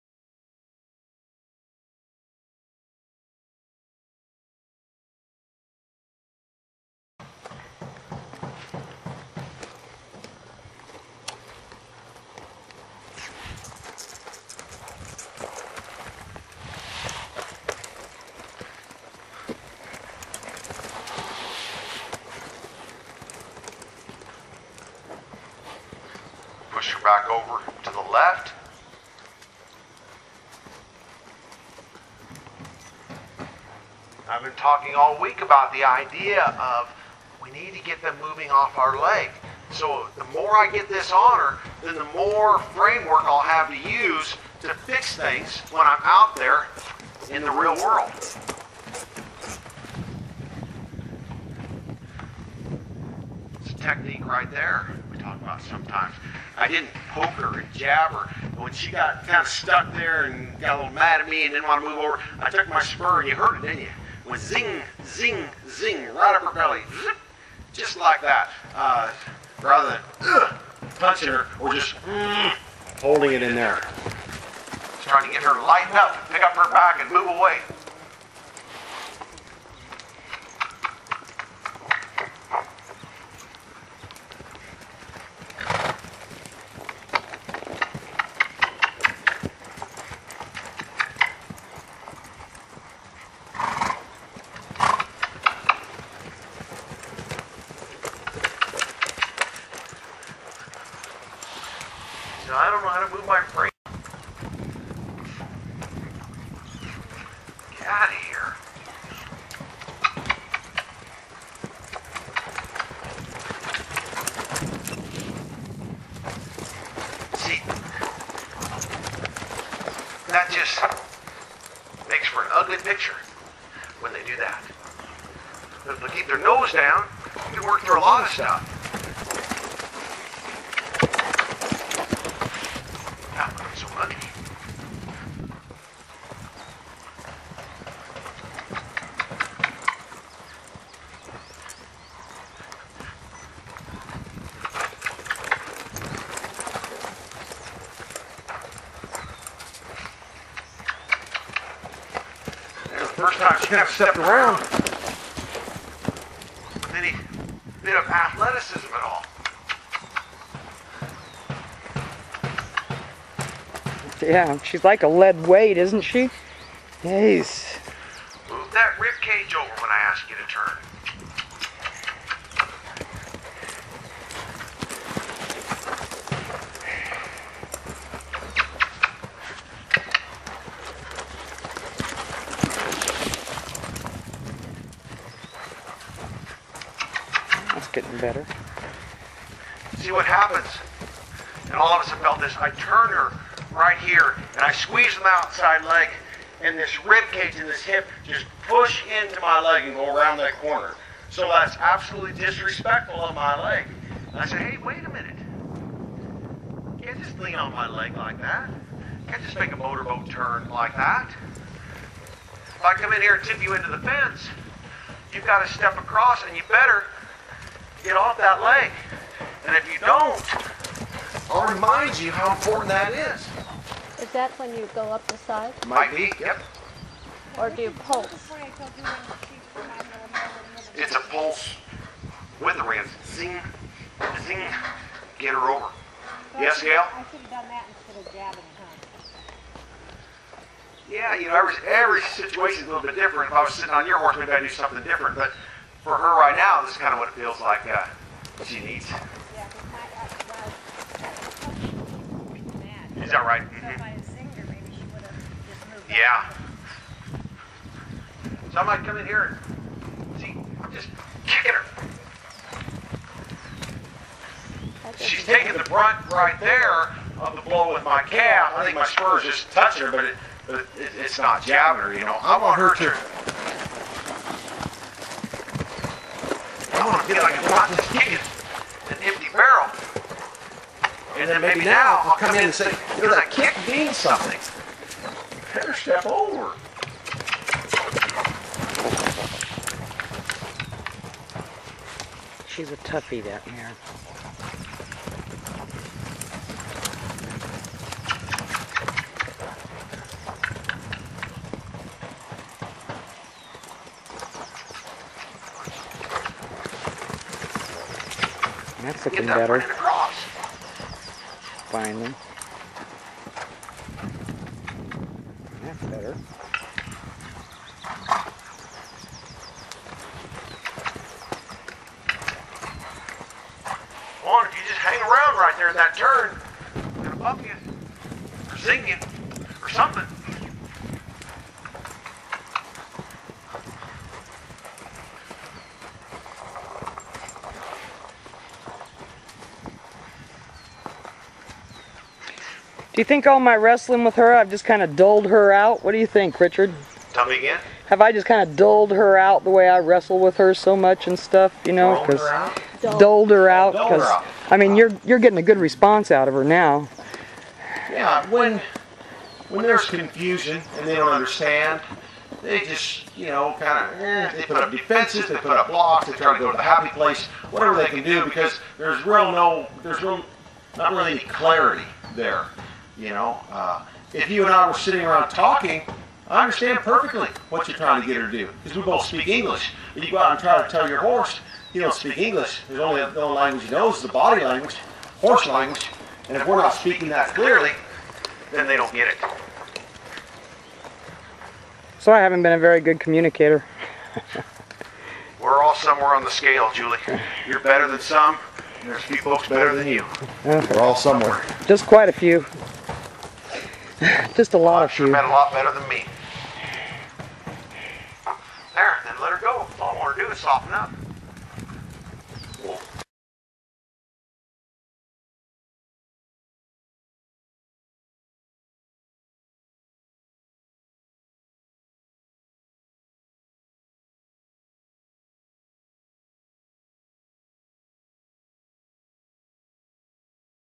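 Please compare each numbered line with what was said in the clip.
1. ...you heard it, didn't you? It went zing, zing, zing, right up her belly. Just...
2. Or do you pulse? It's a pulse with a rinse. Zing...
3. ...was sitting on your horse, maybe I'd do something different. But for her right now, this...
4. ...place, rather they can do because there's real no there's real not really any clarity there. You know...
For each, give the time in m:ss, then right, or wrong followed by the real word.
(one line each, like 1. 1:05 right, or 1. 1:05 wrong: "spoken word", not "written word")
1. 1:03 right
2. 3:47 right
3. 4:03 right
4. 6:07 wrong: "whatever", not "rather".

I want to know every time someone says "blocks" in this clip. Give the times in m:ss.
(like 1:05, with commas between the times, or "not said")
6:05.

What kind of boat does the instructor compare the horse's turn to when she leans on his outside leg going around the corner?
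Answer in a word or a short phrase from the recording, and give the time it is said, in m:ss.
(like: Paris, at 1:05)
motorboat, at 3:29.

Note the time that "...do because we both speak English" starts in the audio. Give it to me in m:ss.
6:18.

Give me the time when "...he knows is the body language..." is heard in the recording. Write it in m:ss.
6:23.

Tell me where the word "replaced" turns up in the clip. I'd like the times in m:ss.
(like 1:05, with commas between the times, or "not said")
not said.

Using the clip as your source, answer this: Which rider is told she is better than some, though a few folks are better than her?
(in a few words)
Julie.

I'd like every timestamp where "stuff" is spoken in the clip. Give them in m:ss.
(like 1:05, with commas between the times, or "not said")
2:08, 5:51.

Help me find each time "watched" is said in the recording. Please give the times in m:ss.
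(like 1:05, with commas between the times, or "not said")
not said.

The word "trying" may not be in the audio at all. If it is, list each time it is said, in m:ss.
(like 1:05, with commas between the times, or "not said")
1:15, 6:17.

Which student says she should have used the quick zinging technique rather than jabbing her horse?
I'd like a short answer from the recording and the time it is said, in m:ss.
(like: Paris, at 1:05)
Gail, at 3:56.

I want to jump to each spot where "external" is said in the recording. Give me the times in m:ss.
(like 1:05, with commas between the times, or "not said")
not said.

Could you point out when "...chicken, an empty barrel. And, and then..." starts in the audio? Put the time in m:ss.
4:38.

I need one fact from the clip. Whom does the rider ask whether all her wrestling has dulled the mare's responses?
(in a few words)
Richard.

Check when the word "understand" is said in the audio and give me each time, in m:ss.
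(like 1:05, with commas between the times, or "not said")
6:01, 6:16.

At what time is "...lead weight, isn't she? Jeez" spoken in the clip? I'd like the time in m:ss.
2:45.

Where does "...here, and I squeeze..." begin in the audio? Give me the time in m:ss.
3:13.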